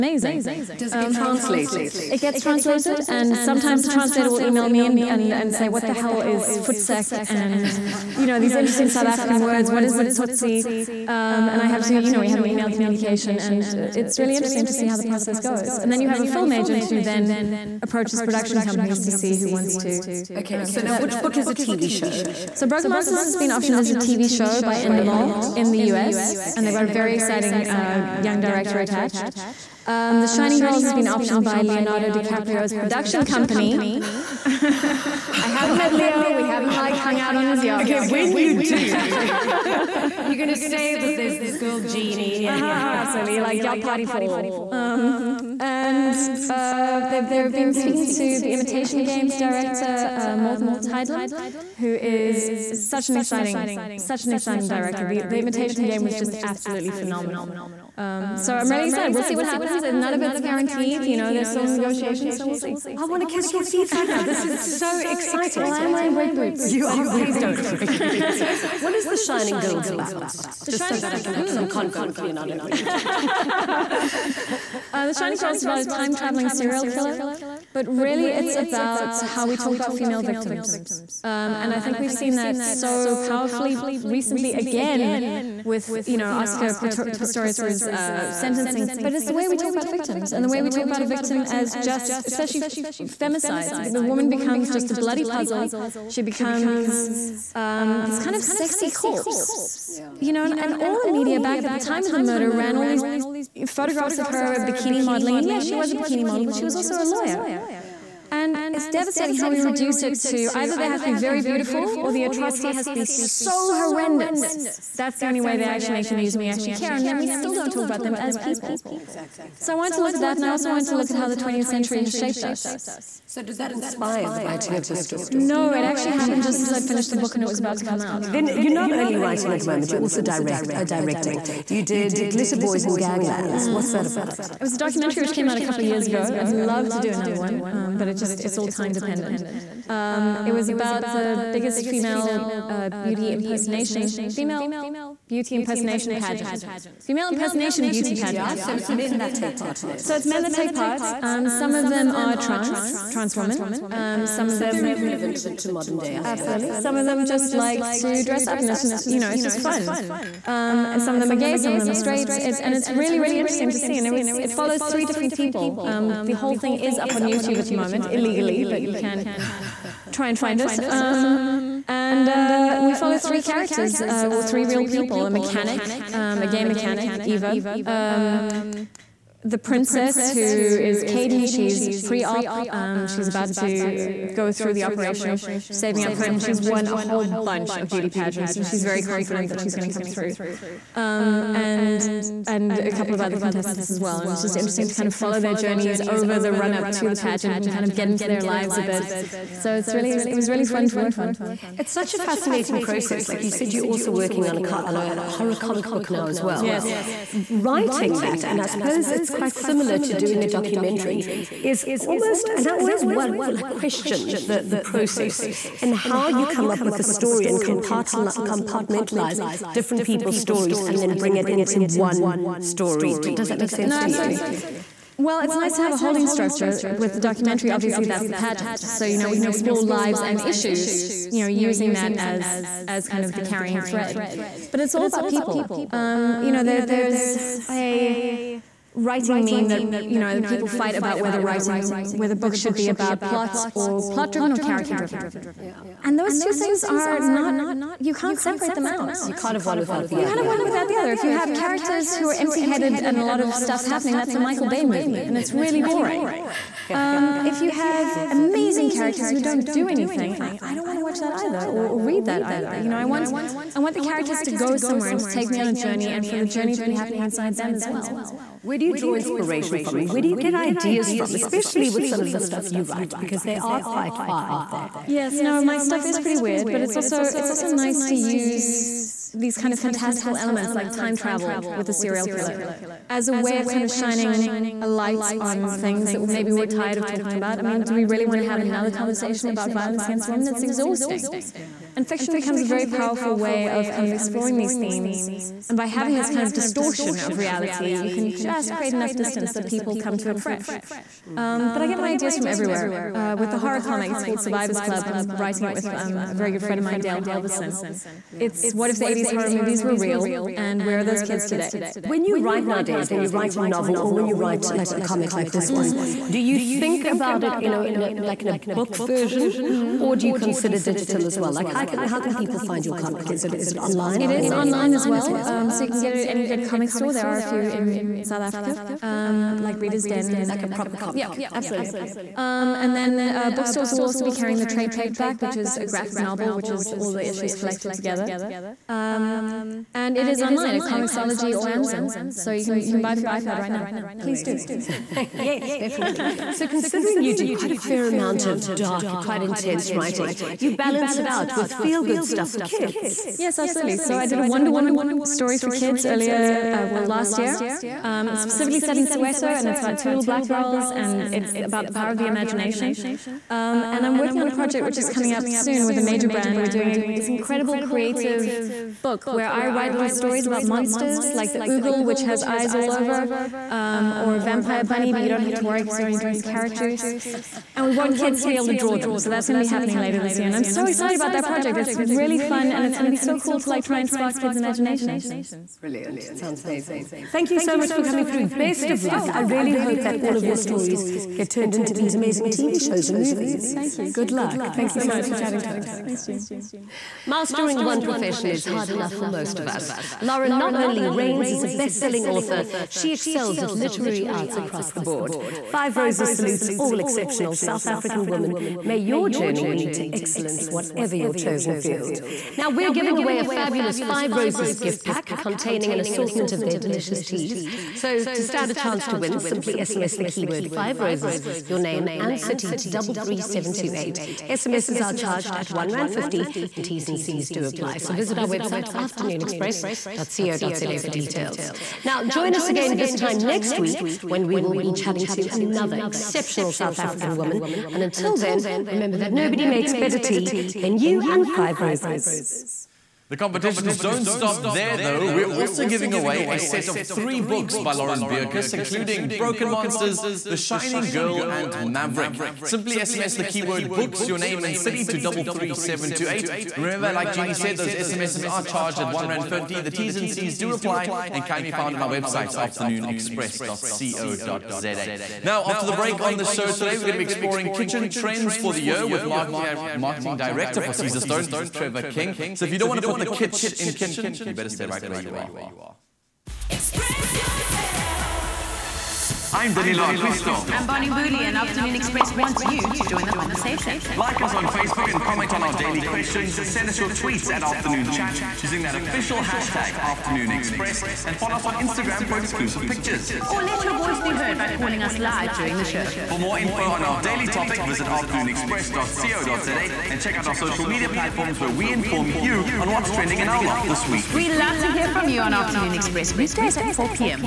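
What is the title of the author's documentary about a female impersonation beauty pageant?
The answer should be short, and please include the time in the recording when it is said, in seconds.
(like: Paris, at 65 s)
Glitter Boys and Ganglands, at 132 s.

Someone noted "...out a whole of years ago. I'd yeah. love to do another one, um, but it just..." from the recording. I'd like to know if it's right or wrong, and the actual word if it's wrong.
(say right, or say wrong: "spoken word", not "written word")
wrong: "couple", not "whole".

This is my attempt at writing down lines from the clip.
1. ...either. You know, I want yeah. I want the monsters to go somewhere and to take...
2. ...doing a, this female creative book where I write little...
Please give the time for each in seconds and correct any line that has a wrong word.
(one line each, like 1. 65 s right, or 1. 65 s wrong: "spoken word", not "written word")
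1. 262 s wrong: "characters", not "monsters"
2. 366 s wrong: "incredible", not "female".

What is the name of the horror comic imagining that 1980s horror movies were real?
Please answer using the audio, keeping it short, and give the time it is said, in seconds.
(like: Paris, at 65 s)
Survivors Club, at 304 s.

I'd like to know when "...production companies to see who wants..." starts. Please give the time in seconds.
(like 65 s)
18 s.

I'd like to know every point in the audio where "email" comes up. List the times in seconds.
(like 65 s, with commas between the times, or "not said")
4 s, 12 s.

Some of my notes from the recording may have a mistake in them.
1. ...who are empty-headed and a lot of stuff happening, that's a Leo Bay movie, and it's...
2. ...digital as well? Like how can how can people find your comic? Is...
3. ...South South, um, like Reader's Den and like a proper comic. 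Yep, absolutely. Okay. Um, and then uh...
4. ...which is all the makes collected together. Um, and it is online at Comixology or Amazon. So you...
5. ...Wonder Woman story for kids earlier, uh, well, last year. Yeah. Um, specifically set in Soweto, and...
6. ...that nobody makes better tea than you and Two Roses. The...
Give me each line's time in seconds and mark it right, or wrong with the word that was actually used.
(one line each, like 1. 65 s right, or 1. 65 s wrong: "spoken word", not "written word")
1. 252 s wrong: "Michael", not "Leo"
2. 320 s right
3. 328 s wrong: "Africa", not "South"
4. 336 s wrong: "issues", not "makes"
5. 354 s right
6. 439 s wrong: "Five", not "Two".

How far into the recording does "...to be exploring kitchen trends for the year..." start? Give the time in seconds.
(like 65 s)
467 s.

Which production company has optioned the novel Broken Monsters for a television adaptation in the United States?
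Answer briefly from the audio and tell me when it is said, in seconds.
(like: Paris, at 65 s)
Endemol, at 24 s.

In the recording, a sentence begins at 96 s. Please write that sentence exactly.
She becomes um, this kind of sexy corpse.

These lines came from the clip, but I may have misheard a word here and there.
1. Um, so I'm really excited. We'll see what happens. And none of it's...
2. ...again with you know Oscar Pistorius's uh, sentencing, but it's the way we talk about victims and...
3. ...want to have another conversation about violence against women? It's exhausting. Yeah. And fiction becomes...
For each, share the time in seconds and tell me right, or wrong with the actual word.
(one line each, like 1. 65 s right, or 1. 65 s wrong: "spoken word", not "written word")
1. 57 s right
2. 84 s right
3. 288 s right.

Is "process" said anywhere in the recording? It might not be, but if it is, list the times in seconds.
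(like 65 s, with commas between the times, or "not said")
15 s, 202 s, 214 s.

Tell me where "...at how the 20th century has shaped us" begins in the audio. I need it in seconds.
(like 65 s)
121 s.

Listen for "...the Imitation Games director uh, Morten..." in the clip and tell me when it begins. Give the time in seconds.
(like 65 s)
48 s.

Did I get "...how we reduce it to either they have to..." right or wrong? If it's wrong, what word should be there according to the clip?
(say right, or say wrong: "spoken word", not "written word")
right.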